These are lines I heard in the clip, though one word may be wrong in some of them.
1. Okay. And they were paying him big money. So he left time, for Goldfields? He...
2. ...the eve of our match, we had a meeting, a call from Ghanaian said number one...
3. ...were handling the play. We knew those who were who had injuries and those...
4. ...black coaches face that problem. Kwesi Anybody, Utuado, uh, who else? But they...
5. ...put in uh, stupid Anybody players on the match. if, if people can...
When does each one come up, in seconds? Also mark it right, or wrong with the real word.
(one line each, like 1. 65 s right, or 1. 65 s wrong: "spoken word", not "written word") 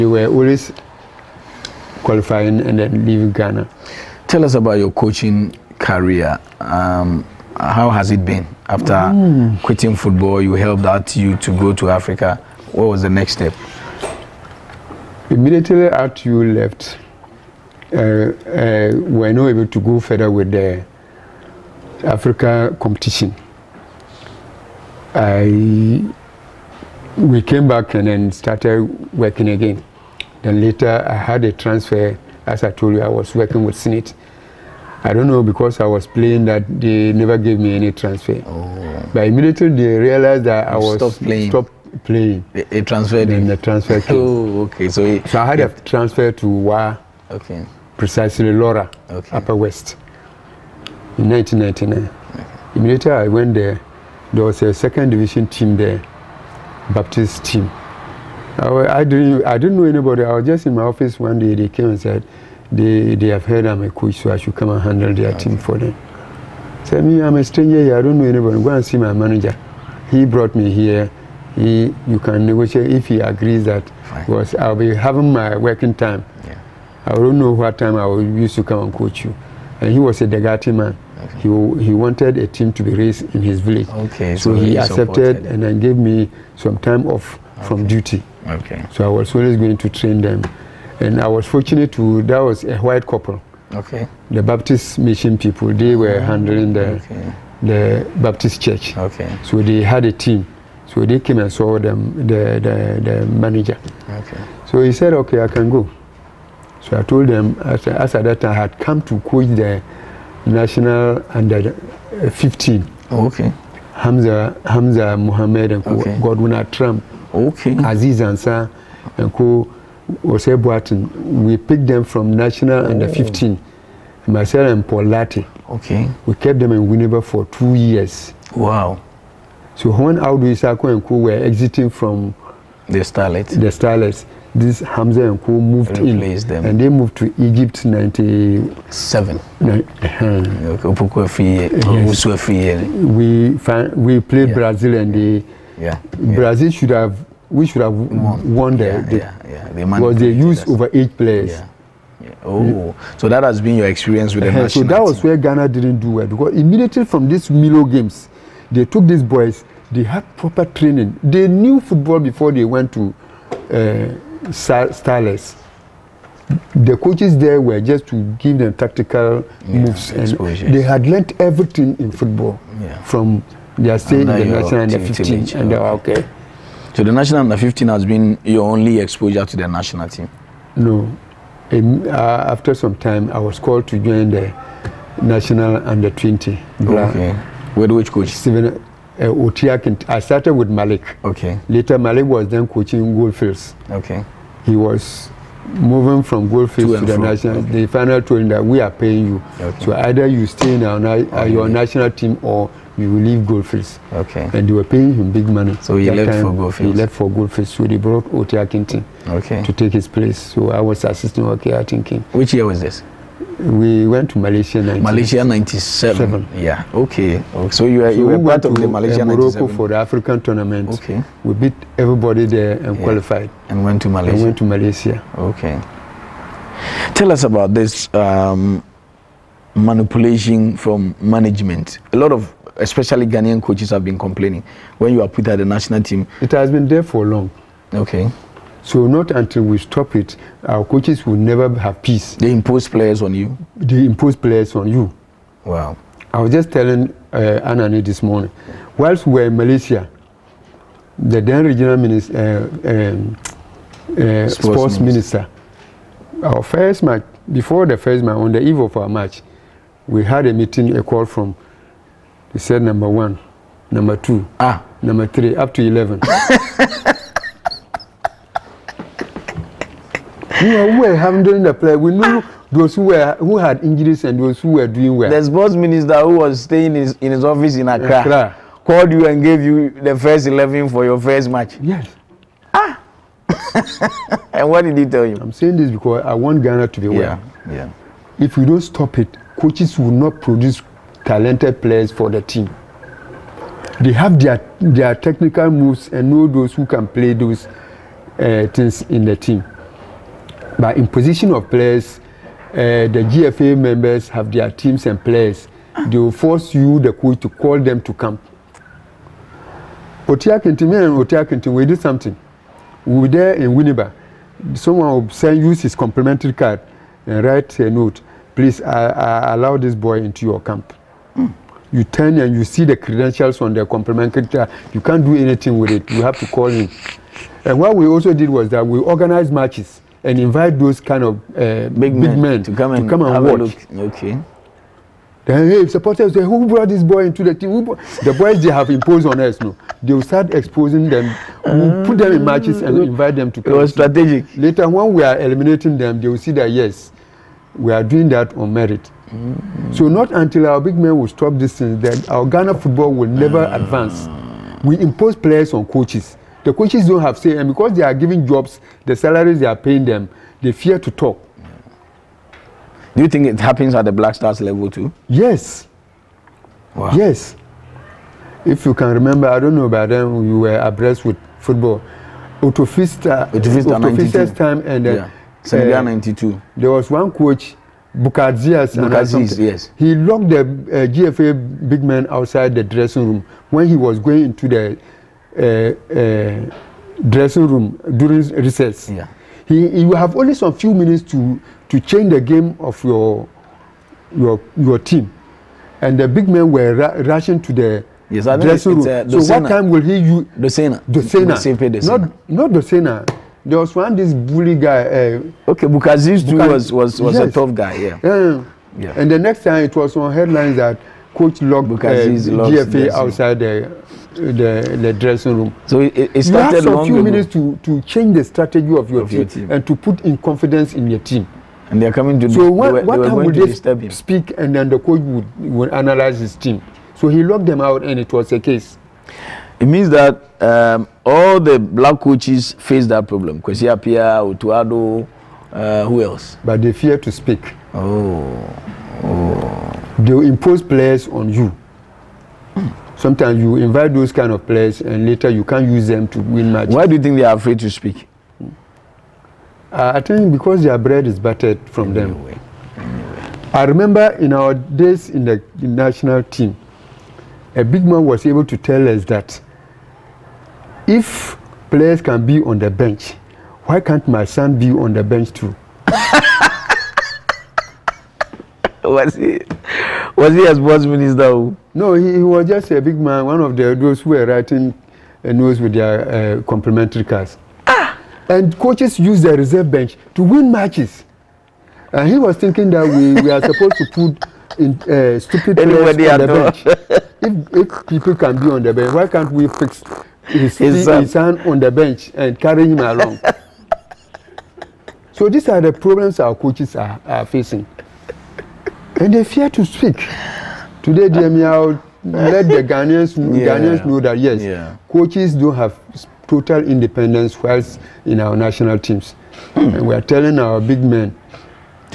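1. 204 s right
2. 258 s wrong: "They", not "Ghanaian"
3. 271 s right
4. 431 s wrong: "Appiah", not "Anybody"
5. 484 s wrong: "bench", not "match".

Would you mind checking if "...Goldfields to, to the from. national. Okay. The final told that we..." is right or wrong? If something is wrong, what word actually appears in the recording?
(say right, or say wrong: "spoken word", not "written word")
right.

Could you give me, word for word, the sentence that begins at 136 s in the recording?
and they moved to Egypt '97.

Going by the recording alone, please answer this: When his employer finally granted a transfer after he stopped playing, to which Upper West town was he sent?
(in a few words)
Lawra.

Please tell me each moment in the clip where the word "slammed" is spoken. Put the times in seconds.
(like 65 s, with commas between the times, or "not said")
not said.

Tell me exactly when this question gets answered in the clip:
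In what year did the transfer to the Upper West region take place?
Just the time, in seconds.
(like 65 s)
51 s.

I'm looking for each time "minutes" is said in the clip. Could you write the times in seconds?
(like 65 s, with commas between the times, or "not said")
390 s, 417 s.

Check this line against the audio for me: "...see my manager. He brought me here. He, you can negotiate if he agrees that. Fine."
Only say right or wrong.
right.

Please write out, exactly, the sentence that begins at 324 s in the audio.
You can't do anything with it.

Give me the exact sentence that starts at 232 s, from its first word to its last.
A lot of especially Ghanaian coaches have been complaining when you are put at the national team.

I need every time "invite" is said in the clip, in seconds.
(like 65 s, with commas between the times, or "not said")
330 s, 343 s, 443 s.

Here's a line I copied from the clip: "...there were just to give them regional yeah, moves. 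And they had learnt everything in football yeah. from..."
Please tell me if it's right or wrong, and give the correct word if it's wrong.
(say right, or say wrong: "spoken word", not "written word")
wrong: "tactical", not "regional".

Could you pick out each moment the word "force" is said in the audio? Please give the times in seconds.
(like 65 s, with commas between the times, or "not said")
306 s.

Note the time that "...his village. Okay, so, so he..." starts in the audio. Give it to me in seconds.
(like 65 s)
83 s.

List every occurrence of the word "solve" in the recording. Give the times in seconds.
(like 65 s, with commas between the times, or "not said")
not said.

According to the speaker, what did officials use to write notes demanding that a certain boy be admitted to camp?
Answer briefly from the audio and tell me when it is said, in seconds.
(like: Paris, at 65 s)
complimentary card, at 315 s.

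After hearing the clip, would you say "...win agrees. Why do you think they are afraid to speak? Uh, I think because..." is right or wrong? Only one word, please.
wrong.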